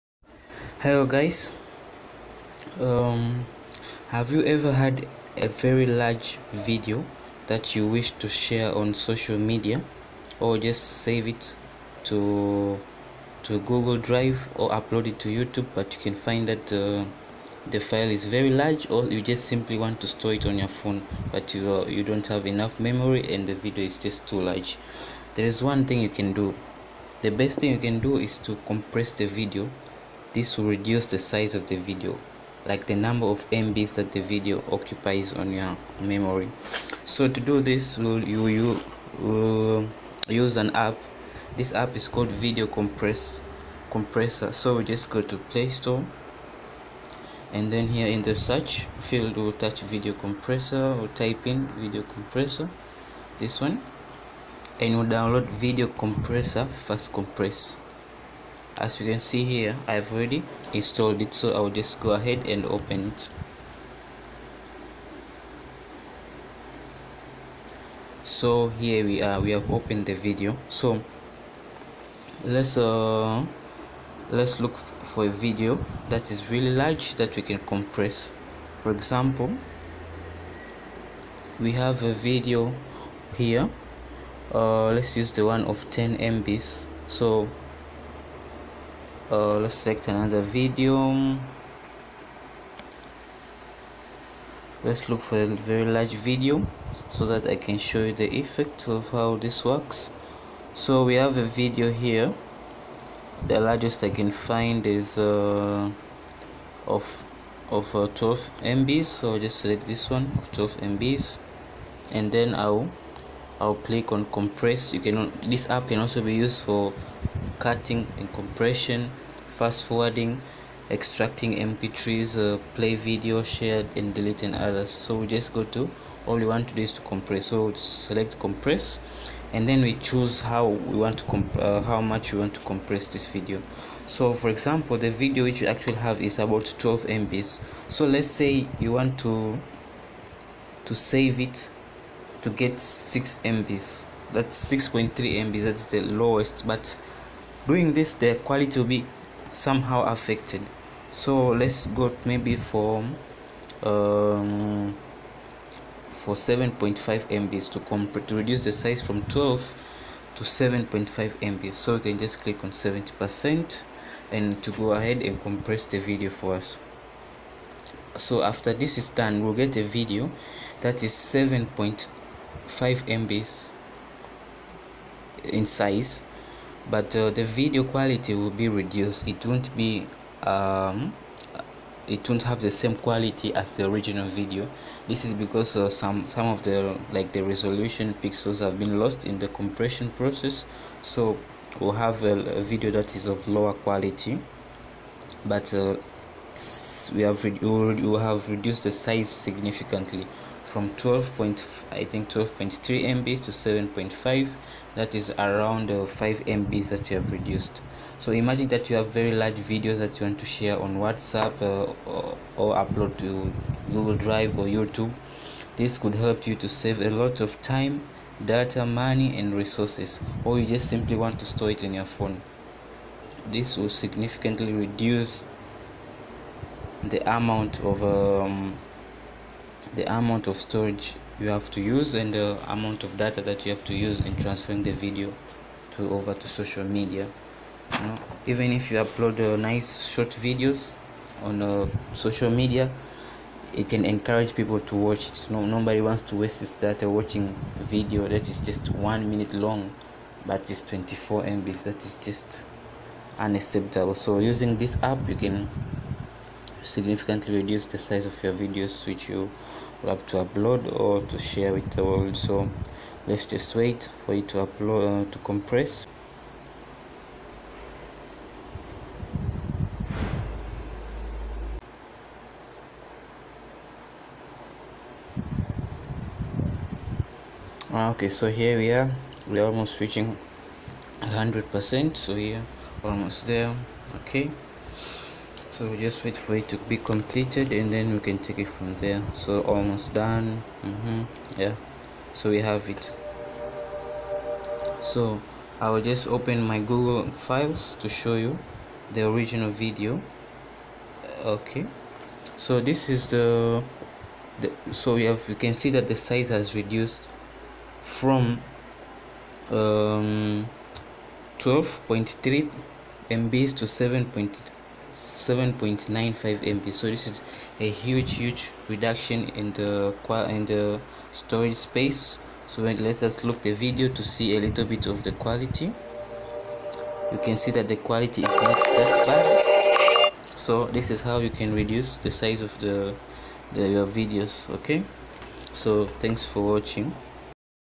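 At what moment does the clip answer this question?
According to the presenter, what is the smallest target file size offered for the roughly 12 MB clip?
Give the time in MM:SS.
02:24.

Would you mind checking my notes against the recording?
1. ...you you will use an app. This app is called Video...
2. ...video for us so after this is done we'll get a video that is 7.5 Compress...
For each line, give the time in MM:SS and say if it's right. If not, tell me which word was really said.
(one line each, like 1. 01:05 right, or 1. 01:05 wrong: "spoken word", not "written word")
1. 00:38 right
2. 02:45 wrong: "MBs", not "Compress".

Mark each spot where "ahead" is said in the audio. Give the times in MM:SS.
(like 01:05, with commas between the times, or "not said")
01:02, 02:44.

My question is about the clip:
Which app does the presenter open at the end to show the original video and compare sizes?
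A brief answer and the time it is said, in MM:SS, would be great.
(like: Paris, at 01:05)
Google Files, at 04:56.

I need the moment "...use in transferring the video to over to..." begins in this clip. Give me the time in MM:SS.
03:53.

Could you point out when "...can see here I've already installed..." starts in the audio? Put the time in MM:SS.
00:59.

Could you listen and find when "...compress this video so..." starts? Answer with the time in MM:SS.
02:12.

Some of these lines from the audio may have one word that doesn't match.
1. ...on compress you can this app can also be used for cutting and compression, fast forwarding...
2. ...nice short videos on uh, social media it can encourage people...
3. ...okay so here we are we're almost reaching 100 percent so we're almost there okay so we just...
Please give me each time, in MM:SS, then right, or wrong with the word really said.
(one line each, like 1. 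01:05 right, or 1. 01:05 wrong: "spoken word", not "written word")
1. 01:54 right
2. 03:59 right
3. 04:38 right.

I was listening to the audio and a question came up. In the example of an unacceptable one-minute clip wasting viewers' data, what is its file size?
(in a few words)
24 MB.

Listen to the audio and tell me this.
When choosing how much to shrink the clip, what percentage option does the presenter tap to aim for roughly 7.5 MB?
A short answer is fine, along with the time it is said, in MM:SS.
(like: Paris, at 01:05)
70%, at 02:42.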